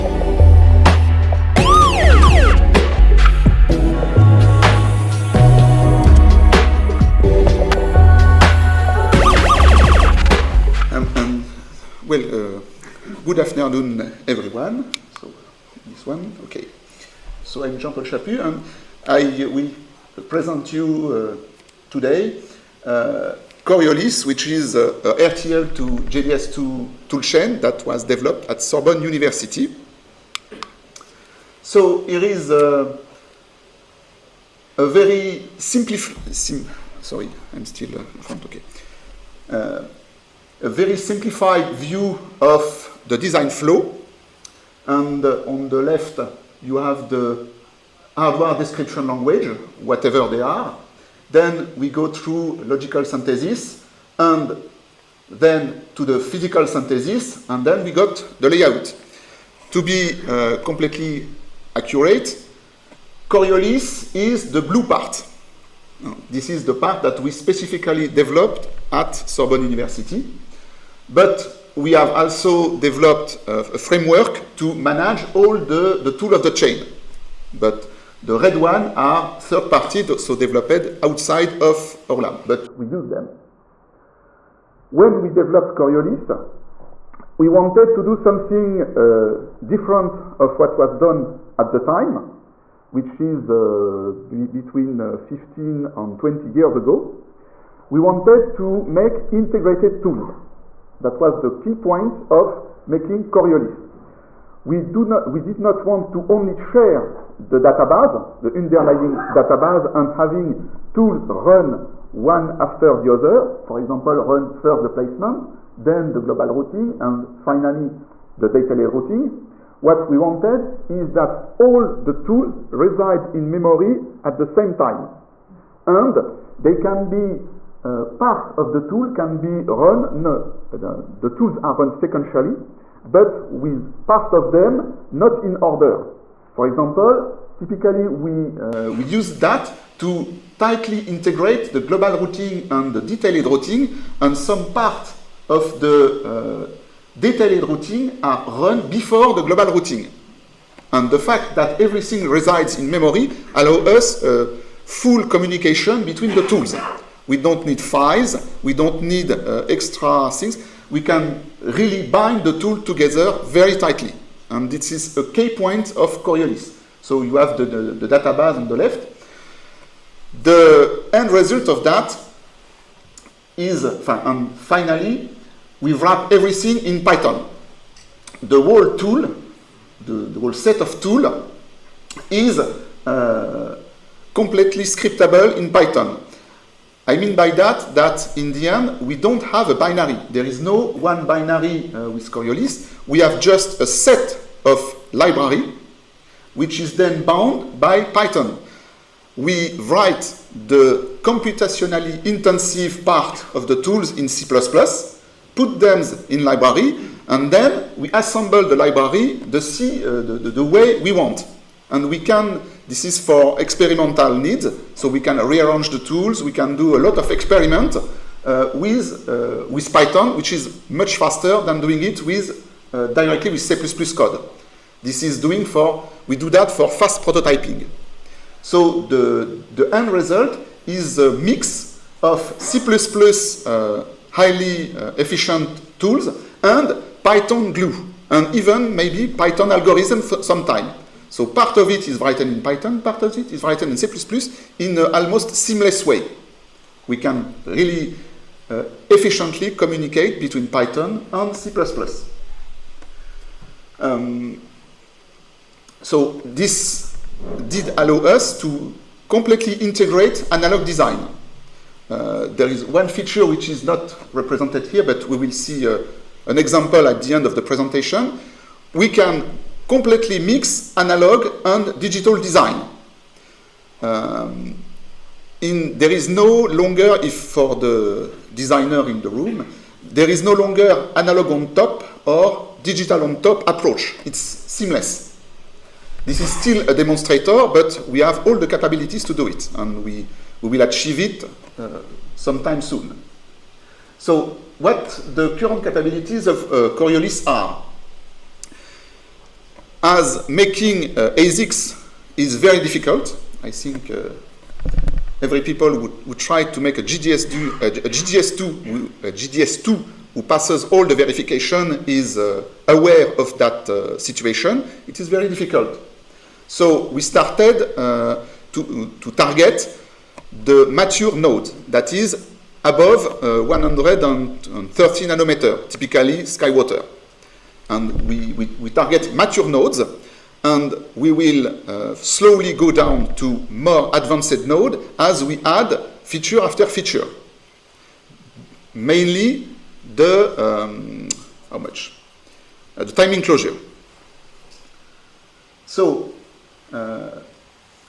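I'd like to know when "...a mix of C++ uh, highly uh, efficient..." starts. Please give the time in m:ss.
3:51.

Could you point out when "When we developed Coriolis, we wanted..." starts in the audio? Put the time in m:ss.
1:24.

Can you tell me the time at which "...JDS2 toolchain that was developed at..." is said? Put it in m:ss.
0:26.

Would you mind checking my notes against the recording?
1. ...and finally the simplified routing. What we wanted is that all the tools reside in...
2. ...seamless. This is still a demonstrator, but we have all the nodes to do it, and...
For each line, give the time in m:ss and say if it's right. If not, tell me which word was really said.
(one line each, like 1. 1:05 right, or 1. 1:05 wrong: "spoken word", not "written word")
1. 1:56 wrong: "detailed", not "simplified"
2. 4:44 wrong: "capabilities", not "nodes".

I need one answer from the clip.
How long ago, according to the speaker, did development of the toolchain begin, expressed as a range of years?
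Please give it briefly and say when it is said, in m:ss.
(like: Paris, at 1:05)
15 to 20 years, at 1:34.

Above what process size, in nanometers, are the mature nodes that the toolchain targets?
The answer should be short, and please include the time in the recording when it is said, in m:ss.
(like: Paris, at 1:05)
130 nanometers, at 5:23.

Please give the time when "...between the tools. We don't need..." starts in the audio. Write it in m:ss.
2:36.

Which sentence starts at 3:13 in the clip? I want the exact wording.
We have just a set of library, which is then bound by Python.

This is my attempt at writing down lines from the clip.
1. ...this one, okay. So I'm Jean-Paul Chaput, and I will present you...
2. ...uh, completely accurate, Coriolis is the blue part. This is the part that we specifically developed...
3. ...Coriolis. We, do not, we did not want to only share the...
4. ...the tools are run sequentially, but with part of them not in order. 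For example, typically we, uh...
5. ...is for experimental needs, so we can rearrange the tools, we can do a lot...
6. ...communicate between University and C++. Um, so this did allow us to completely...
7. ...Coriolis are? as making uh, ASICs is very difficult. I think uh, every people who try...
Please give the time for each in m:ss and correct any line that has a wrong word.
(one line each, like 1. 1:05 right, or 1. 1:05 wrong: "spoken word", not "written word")
1. 0:15 right
2. 1:00 right
3. 1:43 right
4. 2:11 right
5. 3:33 right
6. 4:09 wrong: "Python", not "University"
7. 4:56 right.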